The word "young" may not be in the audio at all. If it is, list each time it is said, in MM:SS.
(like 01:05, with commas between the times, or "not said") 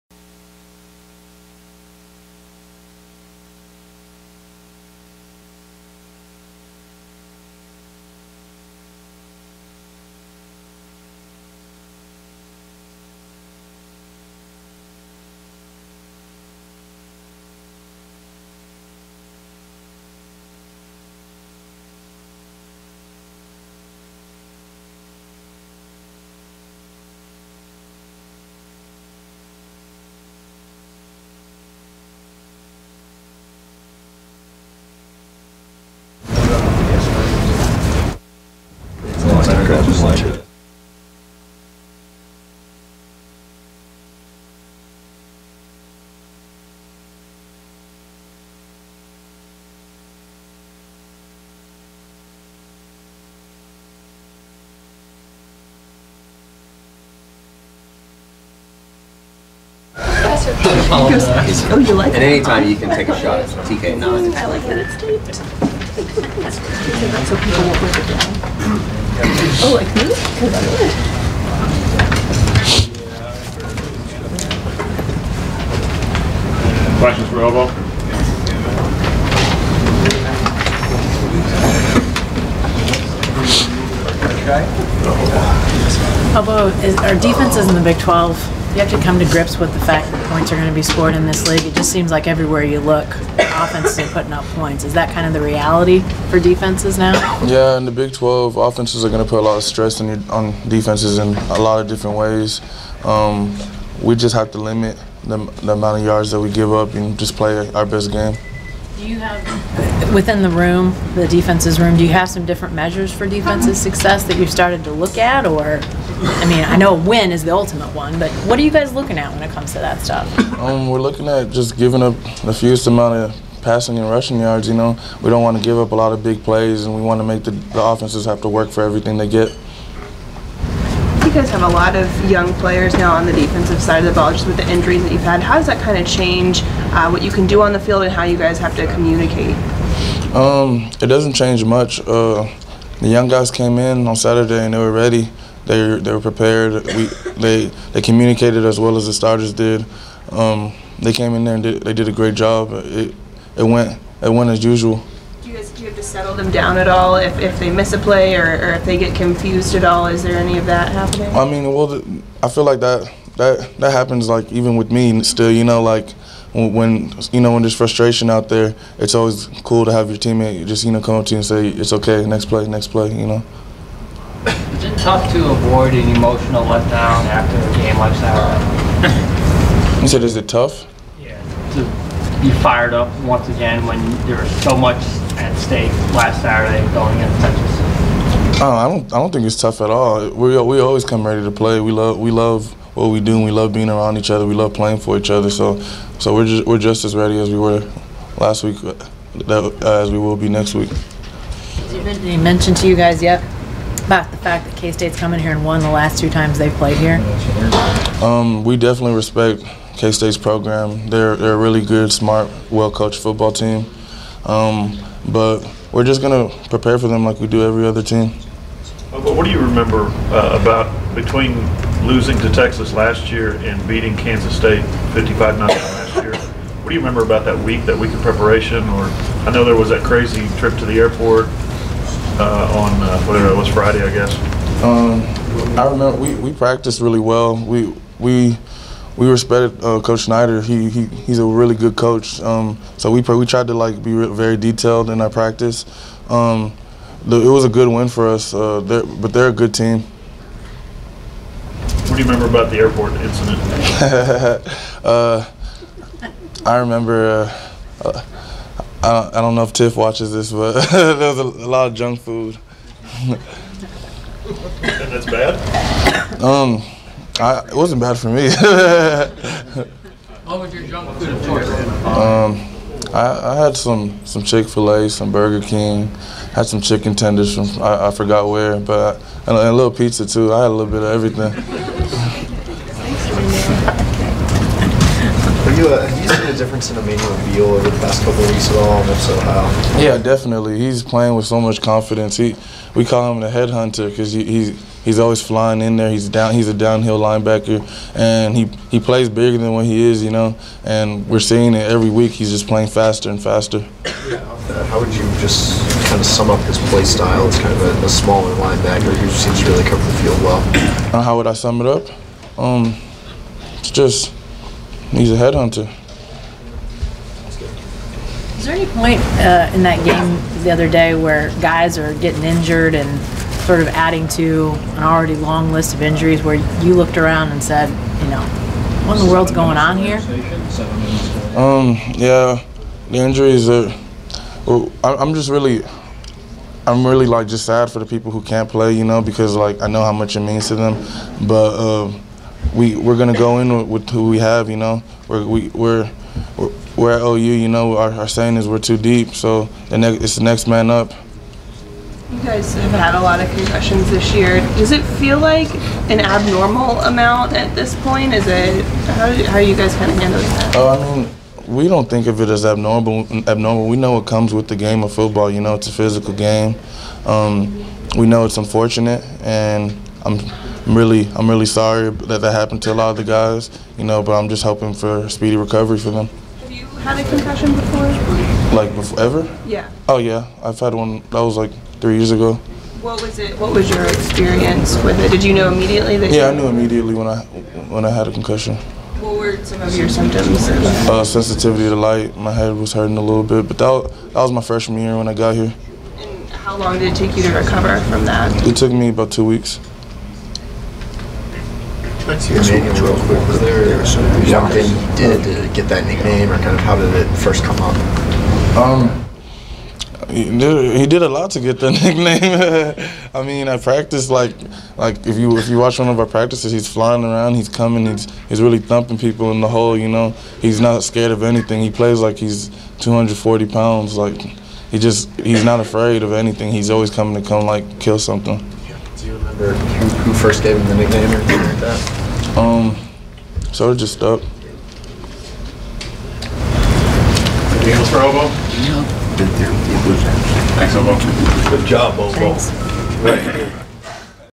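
02:12, 02:23.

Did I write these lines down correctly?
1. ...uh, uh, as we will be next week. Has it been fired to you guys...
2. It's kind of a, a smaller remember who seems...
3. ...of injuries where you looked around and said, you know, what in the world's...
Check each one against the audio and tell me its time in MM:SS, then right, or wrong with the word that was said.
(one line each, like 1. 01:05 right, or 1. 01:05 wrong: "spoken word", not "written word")
1. 03:18 wrong: "mentioned", not "fired"
2. 05:07 wrong: "linebacker", not "remember"
3. 05:25 right.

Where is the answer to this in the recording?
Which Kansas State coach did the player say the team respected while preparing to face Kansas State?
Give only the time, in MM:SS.
04:00.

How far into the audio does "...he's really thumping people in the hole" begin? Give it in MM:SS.
06:58.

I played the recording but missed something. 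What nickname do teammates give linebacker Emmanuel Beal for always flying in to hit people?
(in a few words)
the headhunter.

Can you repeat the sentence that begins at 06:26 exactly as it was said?
Yeah, I knew immediately when I when I had a concussion.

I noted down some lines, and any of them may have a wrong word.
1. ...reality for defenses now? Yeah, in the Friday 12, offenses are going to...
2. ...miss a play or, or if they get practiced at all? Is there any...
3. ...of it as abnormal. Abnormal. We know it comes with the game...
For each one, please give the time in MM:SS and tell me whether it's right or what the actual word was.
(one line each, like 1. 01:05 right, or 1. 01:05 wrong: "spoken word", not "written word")
1. 01:35 wrong: "Big", not "Friday"
2. 02:37 wrong: "confused", not "practiced"
3. 06:02 right.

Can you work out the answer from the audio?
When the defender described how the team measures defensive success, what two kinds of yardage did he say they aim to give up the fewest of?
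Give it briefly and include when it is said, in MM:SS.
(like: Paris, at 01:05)
passing and rushing, at 02:03.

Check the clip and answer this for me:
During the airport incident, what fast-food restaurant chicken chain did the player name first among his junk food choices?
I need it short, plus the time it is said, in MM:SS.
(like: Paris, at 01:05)
Chick Fil A, at 04:34.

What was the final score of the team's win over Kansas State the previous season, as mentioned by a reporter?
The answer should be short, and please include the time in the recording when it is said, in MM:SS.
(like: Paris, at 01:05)
55-9, at 03:45.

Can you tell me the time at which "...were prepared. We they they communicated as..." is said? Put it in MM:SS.
02:26.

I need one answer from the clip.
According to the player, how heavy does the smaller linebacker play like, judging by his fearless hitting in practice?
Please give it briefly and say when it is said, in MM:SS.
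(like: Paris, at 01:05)
240 pounds, at 07:02.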